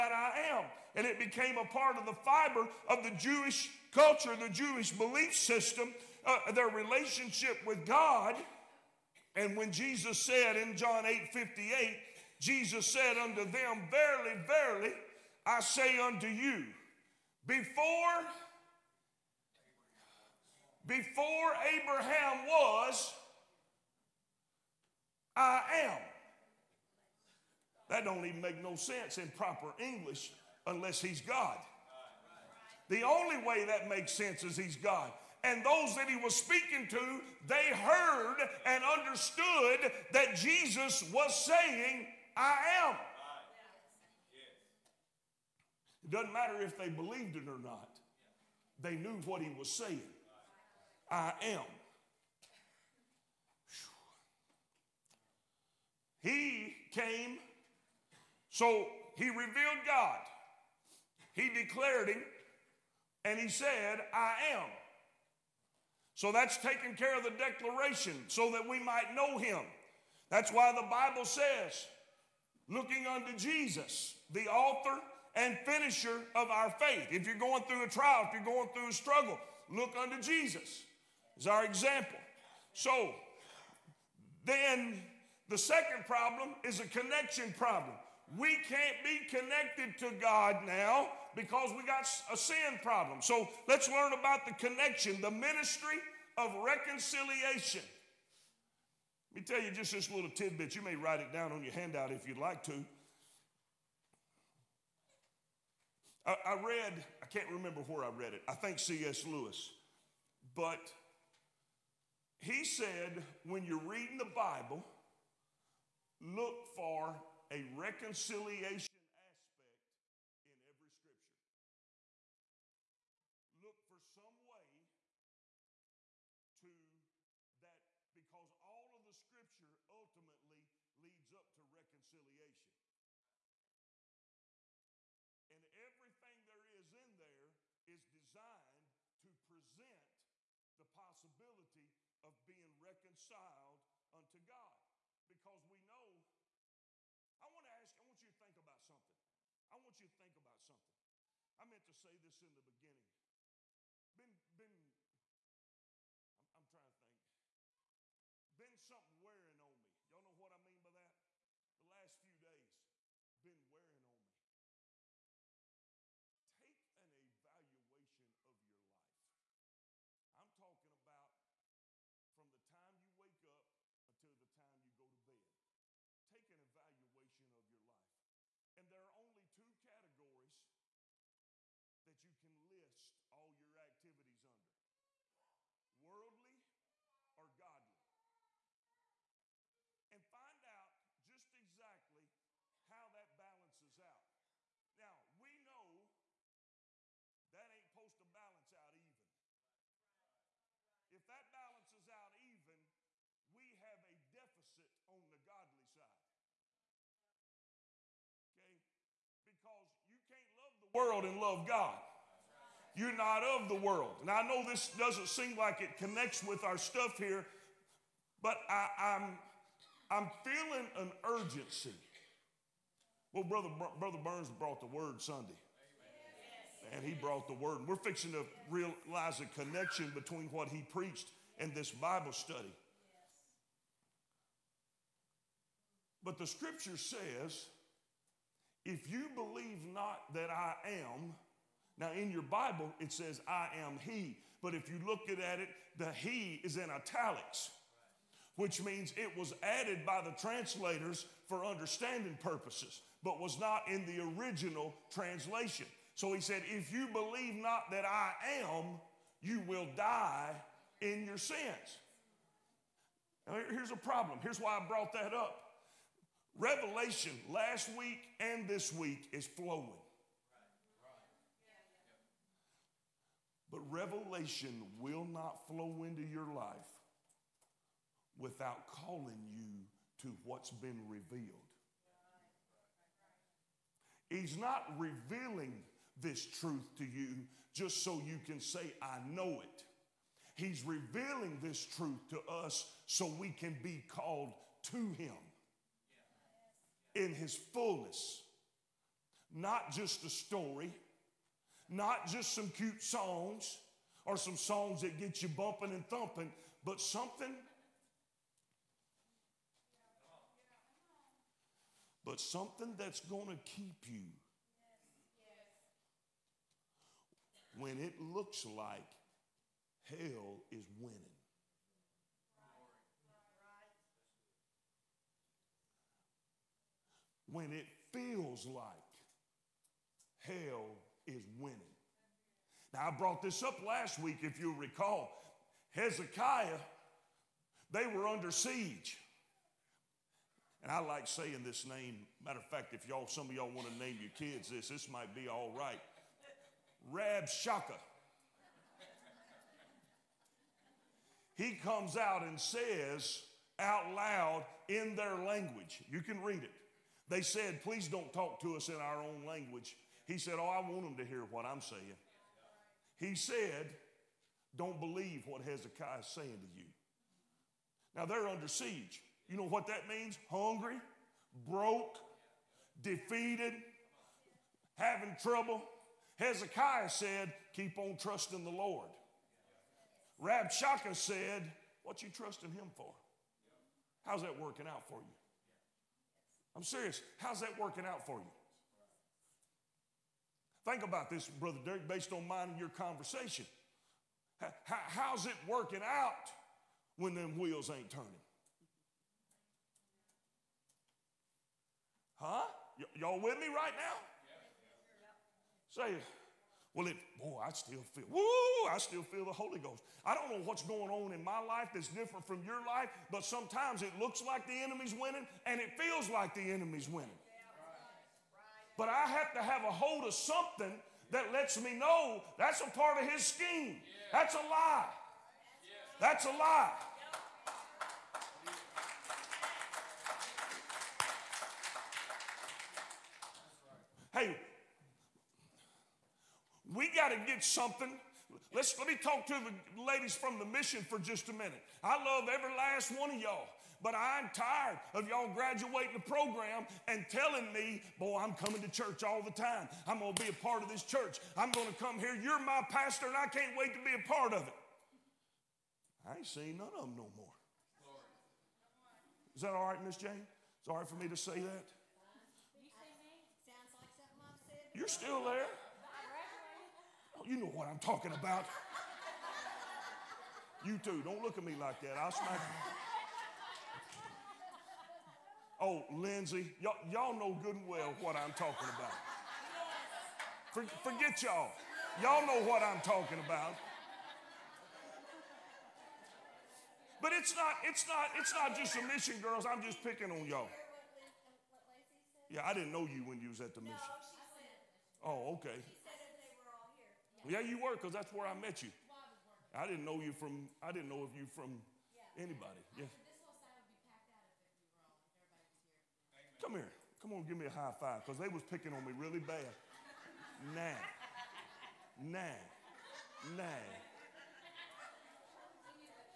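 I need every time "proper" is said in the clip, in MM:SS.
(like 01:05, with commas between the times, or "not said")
00:29.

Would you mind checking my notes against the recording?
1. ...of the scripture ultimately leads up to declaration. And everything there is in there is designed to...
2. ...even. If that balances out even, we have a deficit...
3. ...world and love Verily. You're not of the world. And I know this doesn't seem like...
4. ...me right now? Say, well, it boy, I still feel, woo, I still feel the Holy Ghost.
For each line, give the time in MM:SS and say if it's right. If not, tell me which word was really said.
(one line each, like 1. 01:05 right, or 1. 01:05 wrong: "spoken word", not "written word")
1. 02:08 wrong: "reconciliation", not "declaration"
2. 03:18 right
3. 03:30 wrong: "God", not "Verily"
4. 06:43 right.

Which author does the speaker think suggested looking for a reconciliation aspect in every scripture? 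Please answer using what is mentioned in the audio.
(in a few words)
C.S. Lewis.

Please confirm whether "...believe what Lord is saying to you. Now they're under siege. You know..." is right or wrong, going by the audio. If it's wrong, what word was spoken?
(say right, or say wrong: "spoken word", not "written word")
wrong: "Hezekiah", not "Lord".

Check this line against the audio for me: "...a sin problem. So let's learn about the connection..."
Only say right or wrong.
right.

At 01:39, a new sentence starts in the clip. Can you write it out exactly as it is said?
Let me tell you just this little tidbit.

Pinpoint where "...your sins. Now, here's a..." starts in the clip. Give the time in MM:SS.
04:21.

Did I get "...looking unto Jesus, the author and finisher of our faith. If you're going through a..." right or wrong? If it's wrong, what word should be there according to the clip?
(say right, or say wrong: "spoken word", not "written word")
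right.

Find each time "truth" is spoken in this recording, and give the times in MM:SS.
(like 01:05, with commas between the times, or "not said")
04:46, 04:51.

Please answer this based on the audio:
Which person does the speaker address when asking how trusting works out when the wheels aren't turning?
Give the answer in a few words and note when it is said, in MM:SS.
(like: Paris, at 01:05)
Brother Derek, at 06:31.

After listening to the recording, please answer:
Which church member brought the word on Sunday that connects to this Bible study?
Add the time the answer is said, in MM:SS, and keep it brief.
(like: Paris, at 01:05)
Brother Burns, at 03:43.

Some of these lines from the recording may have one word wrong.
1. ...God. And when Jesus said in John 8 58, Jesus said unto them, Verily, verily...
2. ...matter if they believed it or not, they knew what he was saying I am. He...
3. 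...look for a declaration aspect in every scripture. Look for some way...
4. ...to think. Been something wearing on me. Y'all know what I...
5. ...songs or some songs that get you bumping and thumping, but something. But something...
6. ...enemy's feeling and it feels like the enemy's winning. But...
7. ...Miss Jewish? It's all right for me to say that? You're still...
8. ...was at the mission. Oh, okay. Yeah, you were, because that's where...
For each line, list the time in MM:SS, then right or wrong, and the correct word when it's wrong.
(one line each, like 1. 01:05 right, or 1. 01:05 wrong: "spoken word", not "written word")
1. 00:07 right
2. 00:46 right
3. 01:56 wrong: "reconciliation", not "declaration"
4. 02:36 right
5. 05:03 right
6. 06:54 wrong: "winning", not "feeling"
7. 07:40 wrong: "Jane", not "Jewish"
8. 08:13 right.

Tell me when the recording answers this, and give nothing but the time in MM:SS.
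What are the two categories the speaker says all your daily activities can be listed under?
03:06.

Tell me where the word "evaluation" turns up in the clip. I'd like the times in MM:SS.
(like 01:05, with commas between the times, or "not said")
02:47, 02:56.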